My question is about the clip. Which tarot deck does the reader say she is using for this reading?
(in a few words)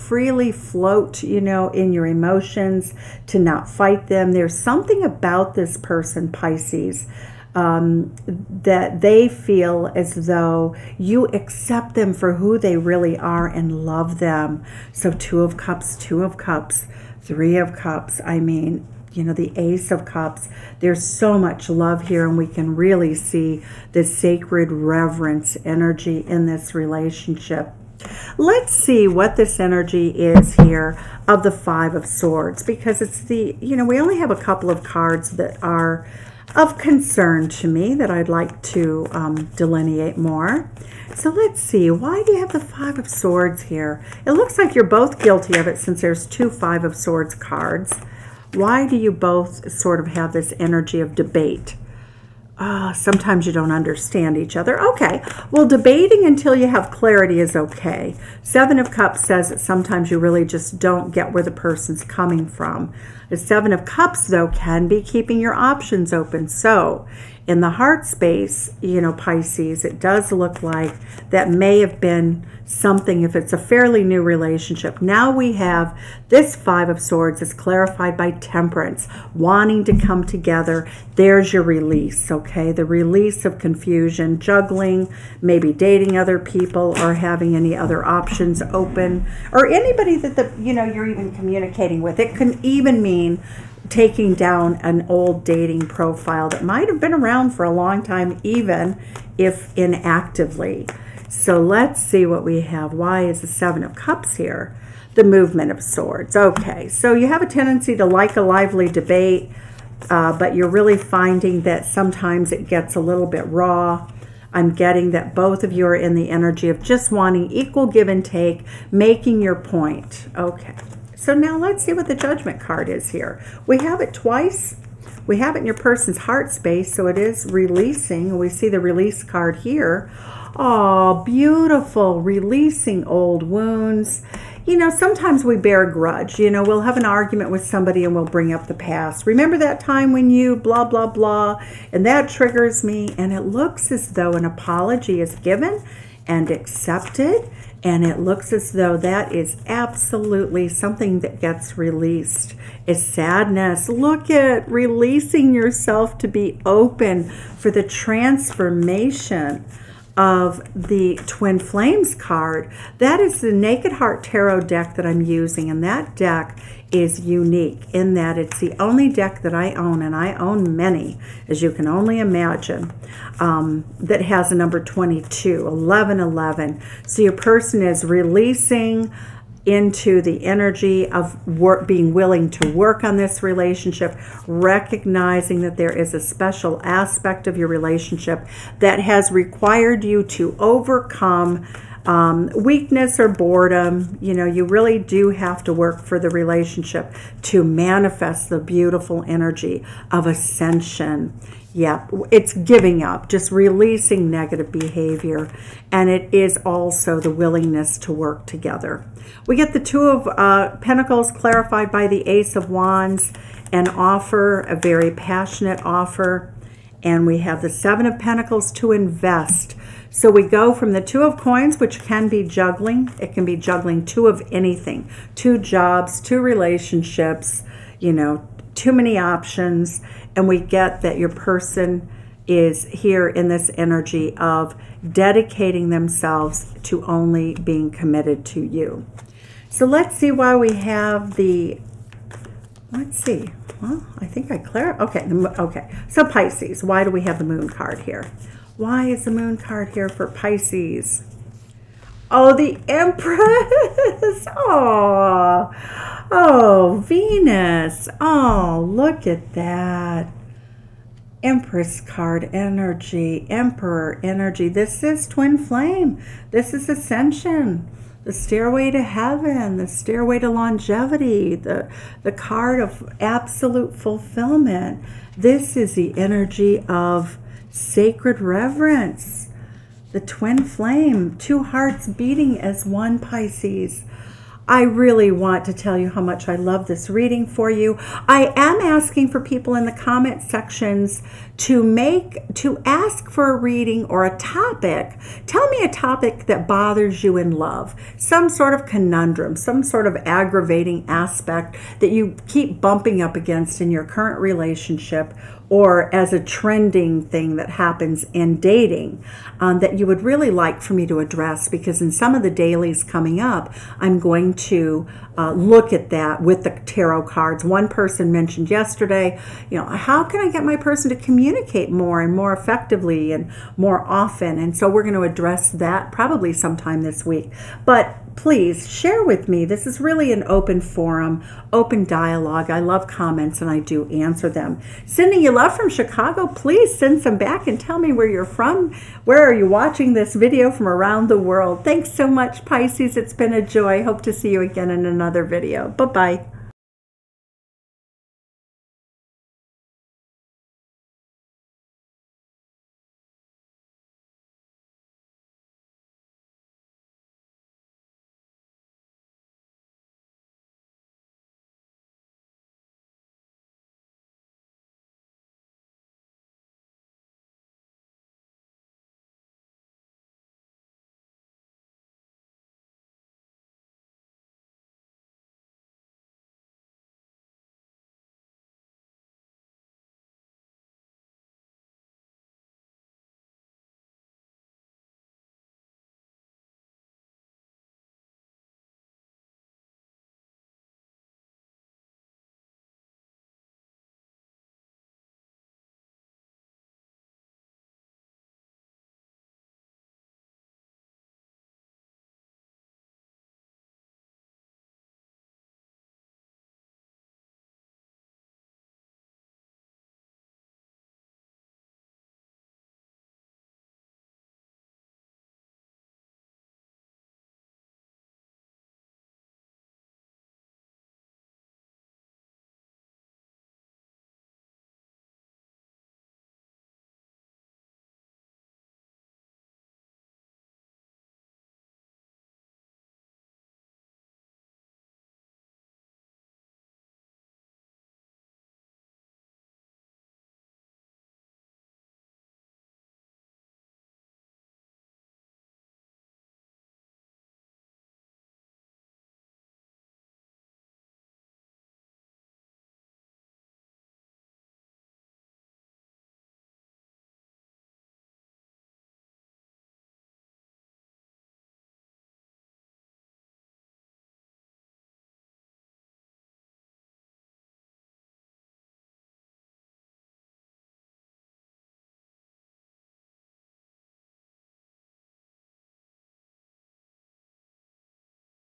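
Naked Heart Tarot.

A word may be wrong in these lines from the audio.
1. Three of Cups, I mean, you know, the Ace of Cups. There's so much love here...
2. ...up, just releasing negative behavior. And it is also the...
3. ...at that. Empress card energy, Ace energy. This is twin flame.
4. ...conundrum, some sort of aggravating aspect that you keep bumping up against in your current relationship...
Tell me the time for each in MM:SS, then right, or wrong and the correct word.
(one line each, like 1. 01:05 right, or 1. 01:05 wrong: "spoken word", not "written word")
1. 00:17 right
2. 03:23 right
3. 04:19 wrong: "Emperor", not "Ace"
4. 04:58 right.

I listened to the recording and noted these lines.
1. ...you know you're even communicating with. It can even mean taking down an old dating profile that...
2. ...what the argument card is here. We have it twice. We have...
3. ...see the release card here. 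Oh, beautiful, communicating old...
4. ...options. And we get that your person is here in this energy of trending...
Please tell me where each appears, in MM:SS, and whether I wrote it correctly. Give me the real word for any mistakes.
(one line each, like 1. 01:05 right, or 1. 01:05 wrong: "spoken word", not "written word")
1. 01:30 right
2. 02:01 wrong: "judgment", not "argument"
3. 02:08 wrong: "releasing", not "communicating"
4. 03:49 wrong: "dedicating", not "trending".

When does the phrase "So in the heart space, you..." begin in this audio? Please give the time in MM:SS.
01:06.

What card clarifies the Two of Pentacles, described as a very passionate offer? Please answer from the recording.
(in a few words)
Ace of Wands.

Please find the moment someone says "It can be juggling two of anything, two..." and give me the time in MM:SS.
03:43.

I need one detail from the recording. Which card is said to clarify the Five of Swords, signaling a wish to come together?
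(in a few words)
Temperance.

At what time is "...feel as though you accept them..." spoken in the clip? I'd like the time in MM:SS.
00:09.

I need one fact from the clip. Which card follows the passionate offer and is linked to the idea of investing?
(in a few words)
Seven of Pentacles.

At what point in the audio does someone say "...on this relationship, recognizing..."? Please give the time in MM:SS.
03:03.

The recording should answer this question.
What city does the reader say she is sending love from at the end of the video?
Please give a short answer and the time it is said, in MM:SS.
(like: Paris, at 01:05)
Chicago, at 05:35.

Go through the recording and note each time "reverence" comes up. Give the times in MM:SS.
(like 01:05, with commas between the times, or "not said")
00:24, 04:38.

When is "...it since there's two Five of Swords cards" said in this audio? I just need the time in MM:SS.
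00:45.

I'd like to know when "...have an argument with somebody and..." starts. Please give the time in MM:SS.
02:16.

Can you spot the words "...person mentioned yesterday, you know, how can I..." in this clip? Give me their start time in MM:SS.
05:17.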